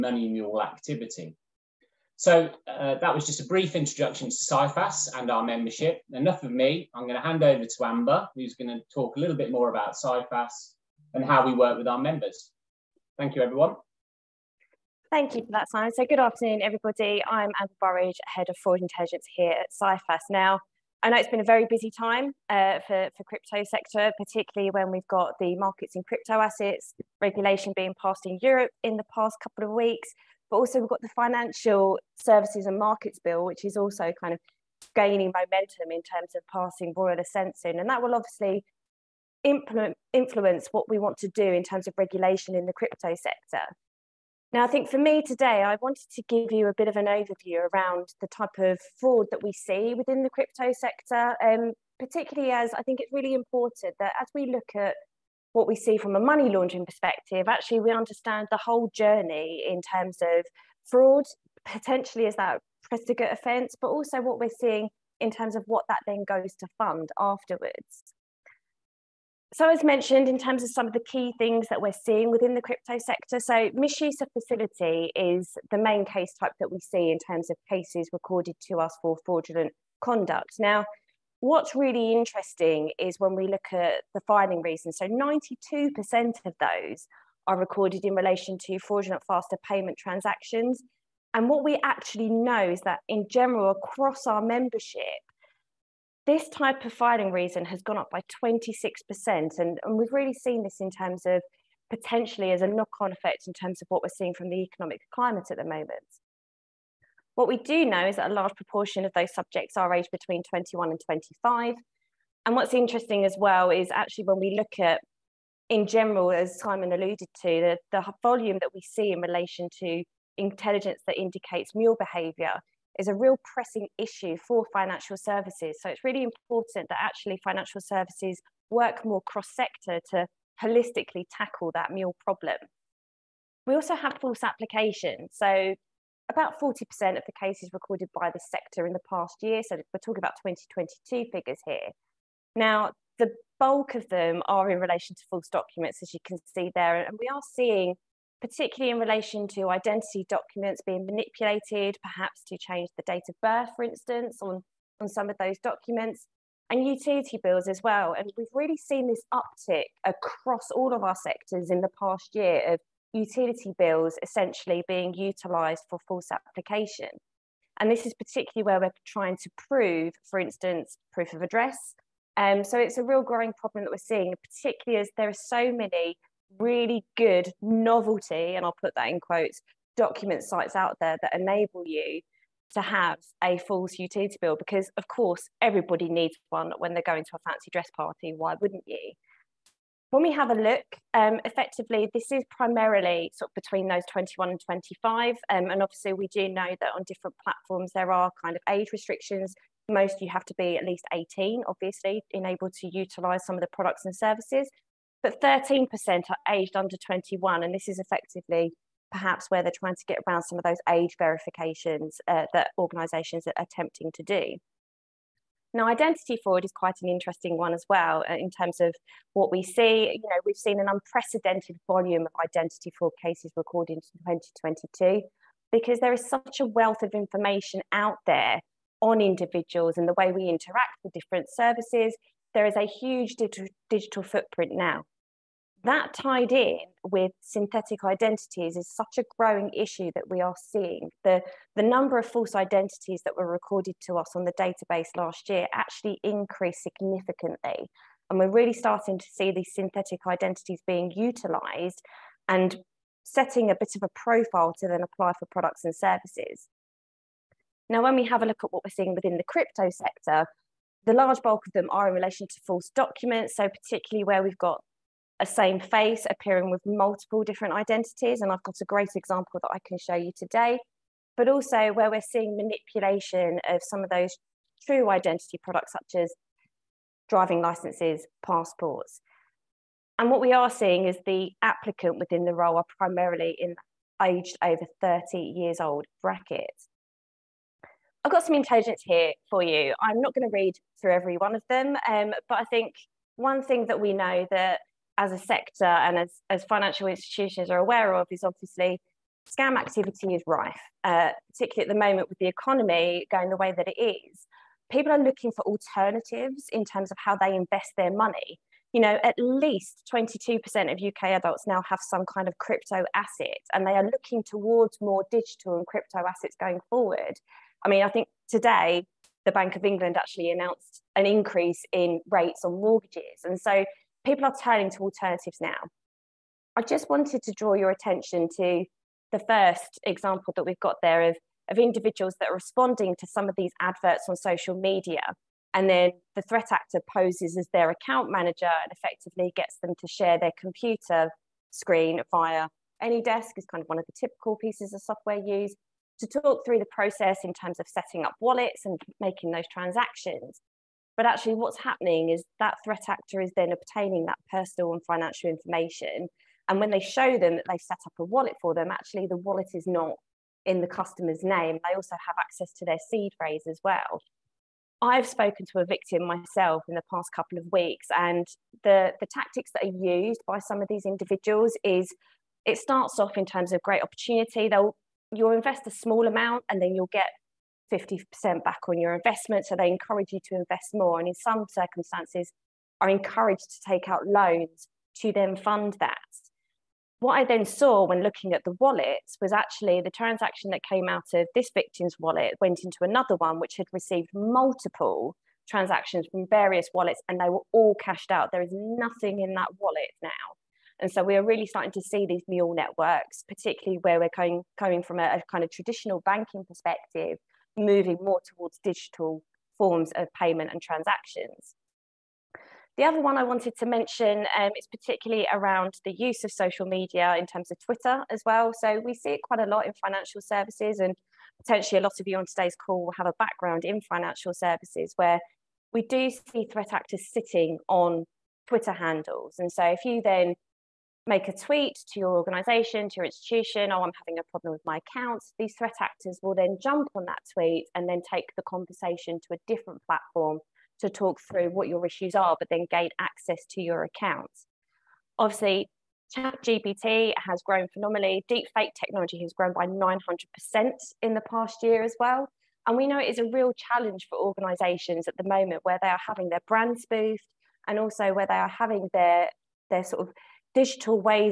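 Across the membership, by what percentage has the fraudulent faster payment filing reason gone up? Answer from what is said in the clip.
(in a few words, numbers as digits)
26%.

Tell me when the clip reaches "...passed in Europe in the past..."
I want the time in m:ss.
0:28.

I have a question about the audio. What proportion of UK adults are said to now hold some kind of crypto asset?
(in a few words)
22%.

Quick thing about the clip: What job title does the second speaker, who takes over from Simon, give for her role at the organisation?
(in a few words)
Head of Fraud Intelligence.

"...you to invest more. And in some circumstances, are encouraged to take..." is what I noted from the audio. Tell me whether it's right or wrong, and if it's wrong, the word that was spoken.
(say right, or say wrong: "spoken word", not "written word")
right.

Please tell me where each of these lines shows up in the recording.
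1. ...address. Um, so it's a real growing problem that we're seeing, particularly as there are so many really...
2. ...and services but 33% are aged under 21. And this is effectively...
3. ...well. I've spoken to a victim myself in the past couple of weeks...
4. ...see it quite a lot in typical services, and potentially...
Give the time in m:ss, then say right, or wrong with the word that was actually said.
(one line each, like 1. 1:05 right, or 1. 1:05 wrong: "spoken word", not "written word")
1. 2:51 right
2. 3:24 wrong: "13", not "33"
3. 6:03 right
4. 6:59 wrong: "financial", not "typical".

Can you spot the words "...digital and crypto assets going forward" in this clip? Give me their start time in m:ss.
5:15.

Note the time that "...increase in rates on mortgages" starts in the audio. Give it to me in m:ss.
5:21.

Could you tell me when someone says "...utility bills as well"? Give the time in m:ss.
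2:36.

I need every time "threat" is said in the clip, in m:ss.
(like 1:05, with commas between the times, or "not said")
5:36, 5:52, 7:06, 7:15.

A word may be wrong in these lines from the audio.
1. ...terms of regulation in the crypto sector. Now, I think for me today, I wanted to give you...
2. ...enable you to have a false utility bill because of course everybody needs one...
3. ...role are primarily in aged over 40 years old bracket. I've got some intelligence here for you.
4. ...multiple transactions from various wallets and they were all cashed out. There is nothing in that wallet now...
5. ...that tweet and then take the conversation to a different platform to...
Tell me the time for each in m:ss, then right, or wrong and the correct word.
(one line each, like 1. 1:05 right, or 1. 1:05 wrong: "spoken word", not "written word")
1. 0:41 right
2. 3:01 right
3. 4:42 wrong: "30", not "40"
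4. 6:34 right
5. 7:17 right.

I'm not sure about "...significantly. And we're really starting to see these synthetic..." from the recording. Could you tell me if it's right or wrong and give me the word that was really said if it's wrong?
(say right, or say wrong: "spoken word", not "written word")
right.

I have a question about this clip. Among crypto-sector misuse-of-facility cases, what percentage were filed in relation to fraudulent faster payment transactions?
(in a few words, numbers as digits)
92%.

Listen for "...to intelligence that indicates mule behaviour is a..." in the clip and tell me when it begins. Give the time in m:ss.
1:59.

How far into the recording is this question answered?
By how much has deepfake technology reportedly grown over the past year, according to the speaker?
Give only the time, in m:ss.
7:29.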